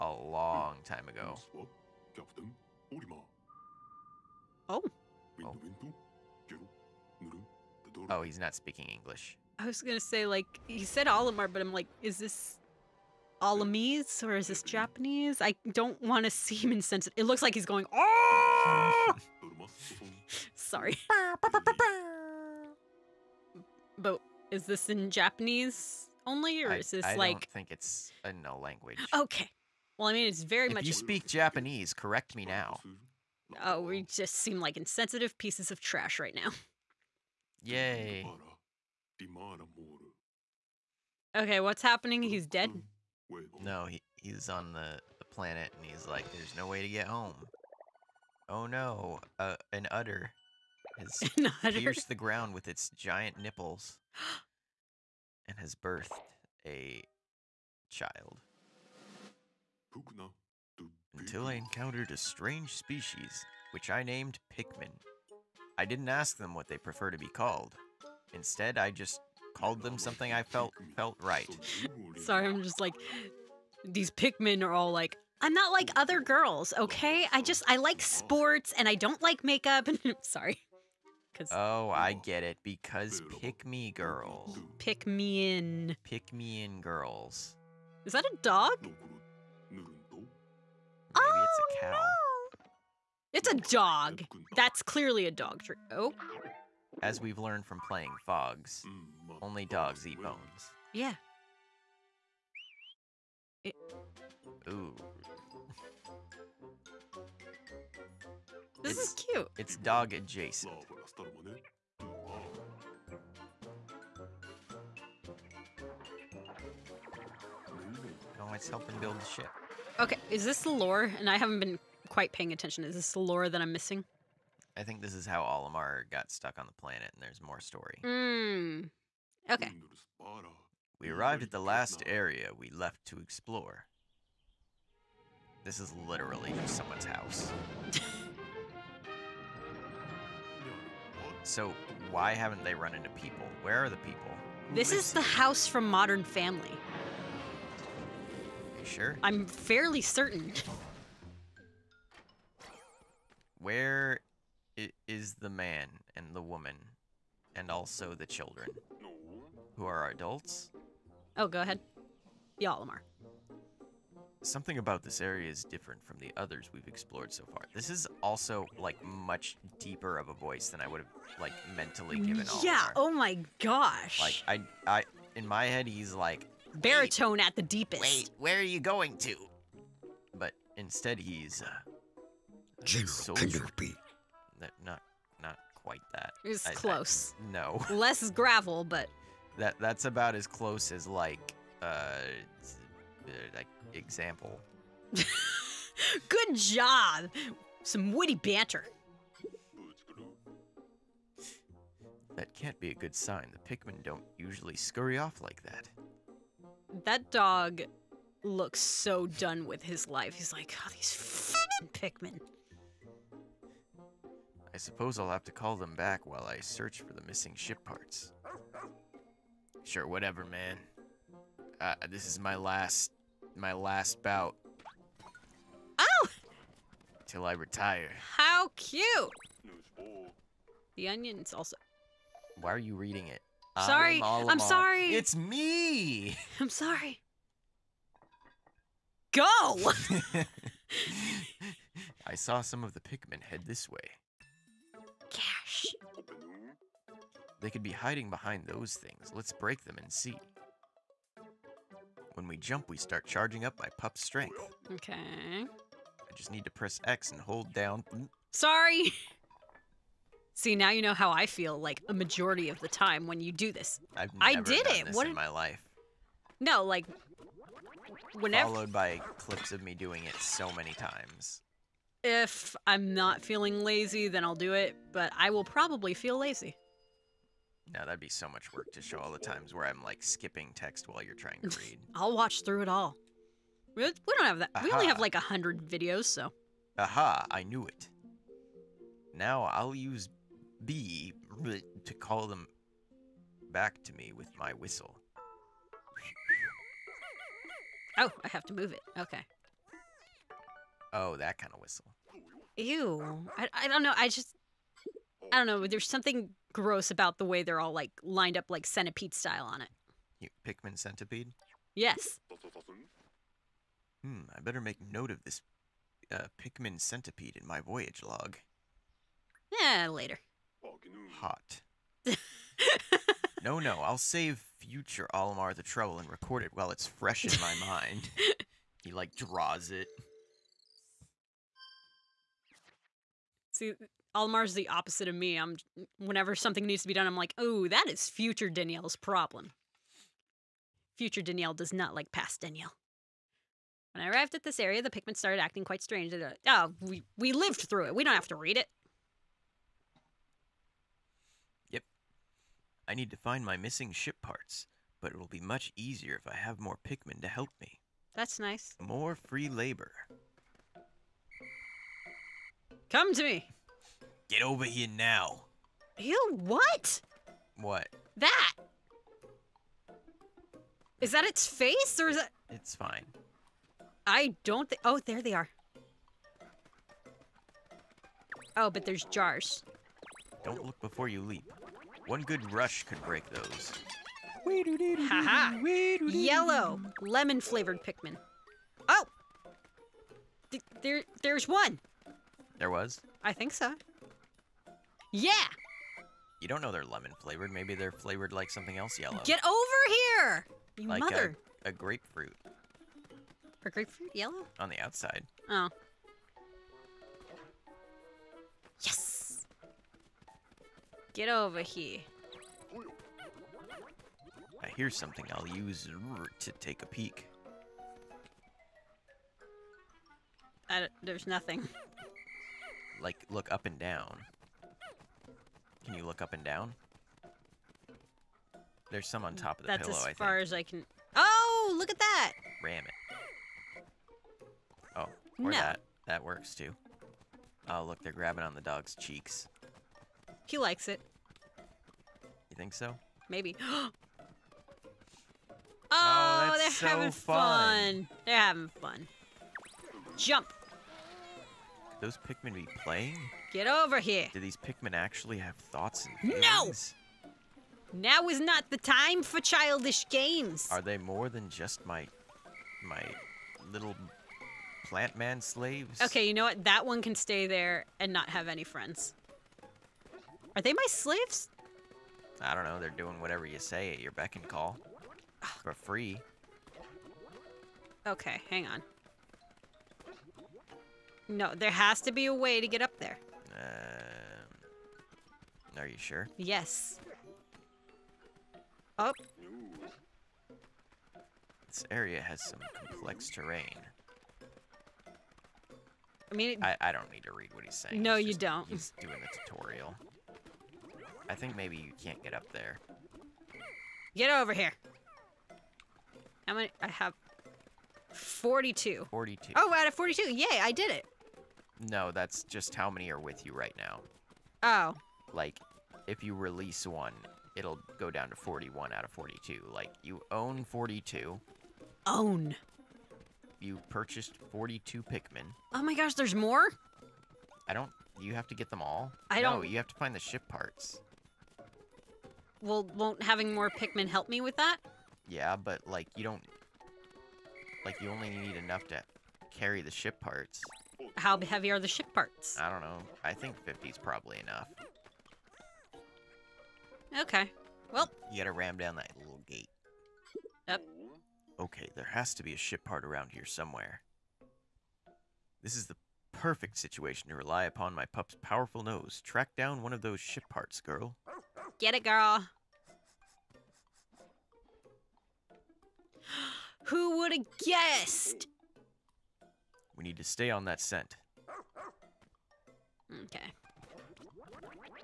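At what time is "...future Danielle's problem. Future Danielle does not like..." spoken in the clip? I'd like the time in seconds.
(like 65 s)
338 s.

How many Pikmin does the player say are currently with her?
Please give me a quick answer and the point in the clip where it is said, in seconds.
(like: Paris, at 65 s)
42, at 507 s.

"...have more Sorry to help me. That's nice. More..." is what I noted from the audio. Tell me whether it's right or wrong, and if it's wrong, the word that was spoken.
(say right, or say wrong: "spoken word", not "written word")
wrong: "Pikmin", not "Sorry".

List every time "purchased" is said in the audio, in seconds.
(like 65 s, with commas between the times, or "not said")
524 s.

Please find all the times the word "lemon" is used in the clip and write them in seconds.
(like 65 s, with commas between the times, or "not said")
387 s, 397 s.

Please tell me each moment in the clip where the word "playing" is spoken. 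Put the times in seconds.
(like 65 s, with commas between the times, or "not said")
97 s, 453 s.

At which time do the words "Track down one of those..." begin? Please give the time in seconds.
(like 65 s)
559 s.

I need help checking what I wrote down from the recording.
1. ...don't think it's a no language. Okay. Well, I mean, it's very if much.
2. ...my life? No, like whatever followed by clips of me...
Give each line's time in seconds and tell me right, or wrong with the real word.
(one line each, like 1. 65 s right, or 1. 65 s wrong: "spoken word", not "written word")
1. 27 s right
2. 265 s wrong: "whenever", not "whatever".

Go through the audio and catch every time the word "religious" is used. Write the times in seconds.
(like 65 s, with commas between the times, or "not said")
not said.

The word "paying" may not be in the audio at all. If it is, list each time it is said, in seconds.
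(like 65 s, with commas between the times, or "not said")
122 s.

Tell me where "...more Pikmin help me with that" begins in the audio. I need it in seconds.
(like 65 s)
533 s.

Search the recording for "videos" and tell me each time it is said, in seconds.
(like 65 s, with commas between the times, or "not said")
285 s.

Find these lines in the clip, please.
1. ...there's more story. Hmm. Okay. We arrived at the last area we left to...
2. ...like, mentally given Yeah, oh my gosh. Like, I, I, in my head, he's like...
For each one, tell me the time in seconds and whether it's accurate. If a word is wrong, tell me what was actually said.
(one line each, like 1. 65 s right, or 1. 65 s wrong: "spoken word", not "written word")
1. 127 s right
2. 171 s right.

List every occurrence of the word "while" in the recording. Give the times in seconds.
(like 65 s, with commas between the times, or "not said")
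216 s, 281 s, 326 s.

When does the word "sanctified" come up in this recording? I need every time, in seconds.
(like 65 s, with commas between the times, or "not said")
not said.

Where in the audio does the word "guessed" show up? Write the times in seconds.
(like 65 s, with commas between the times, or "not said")
567 s.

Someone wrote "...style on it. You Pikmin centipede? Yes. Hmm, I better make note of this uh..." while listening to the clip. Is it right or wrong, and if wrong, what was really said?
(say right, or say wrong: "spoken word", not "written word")
right.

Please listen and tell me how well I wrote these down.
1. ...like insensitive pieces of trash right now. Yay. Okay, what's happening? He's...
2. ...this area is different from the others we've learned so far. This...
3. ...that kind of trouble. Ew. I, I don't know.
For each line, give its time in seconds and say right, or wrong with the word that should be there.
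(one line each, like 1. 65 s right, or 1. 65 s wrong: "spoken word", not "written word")
1. 34 s right
2. 165 s wrong: "explored", not "learned"
3. 301 s wrong: "whistle", not "trouble".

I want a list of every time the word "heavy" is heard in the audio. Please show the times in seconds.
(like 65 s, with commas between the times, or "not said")
541 s.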